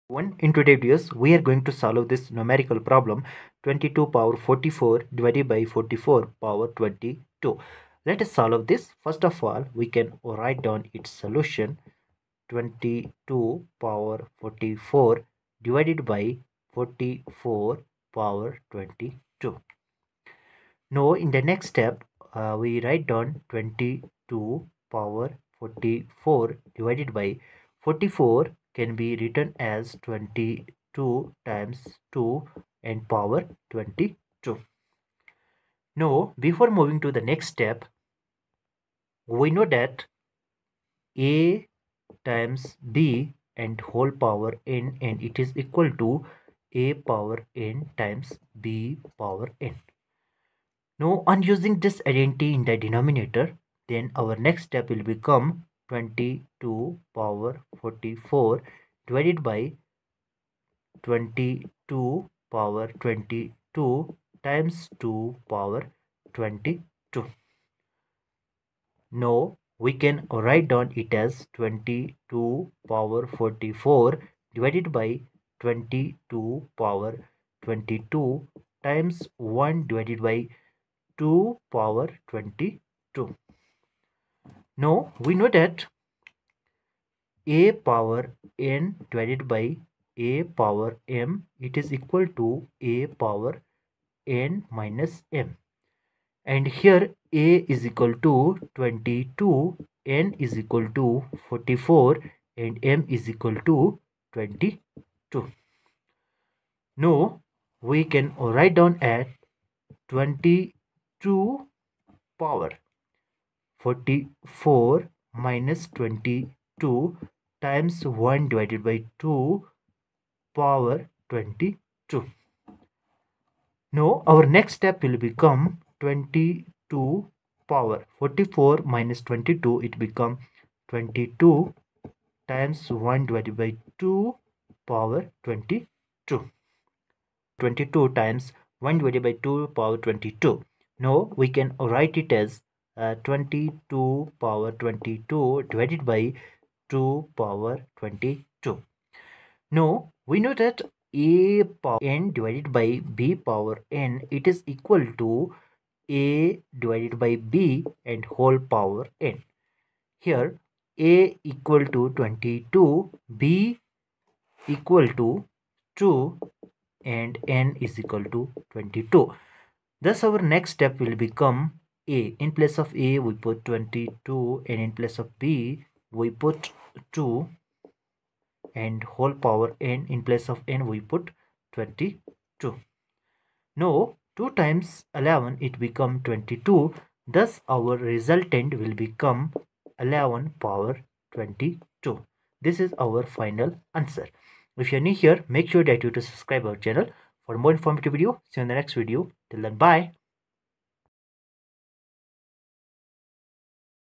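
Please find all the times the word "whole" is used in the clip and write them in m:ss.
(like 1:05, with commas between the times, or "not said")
0:43, 2:38, 2:59.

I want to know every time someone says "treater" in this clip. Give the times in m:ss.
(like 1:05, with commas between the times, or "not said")
not said.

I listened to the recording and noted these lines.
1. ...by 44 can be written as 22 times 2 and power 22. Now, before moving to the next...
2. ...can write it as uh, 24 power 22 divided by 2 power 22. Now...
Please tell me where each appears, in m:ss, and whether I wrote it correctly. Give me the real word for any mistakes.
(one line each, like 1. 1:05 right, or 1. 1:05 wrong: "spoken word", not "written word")
1. 0:27 right
2. 2:21 wrong: "22", not "24".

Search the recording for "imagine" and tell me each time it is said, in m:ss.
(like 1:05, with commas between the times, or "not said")
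not said.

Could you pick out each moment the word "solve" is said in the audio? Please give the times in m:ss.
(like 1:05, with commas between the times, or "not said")
0:01, 0:08.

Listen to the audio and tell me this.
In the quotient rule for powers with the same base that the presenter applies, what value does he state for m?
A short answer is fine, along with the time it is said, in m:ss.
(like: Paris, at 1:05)
22, at 1:42.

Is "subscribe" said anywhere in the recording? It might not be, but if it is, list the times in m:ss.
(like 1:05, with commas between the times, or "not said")
3:16.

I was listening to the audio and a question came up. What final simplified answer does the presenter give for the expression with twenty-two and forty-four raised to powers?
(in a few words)
11 power 22.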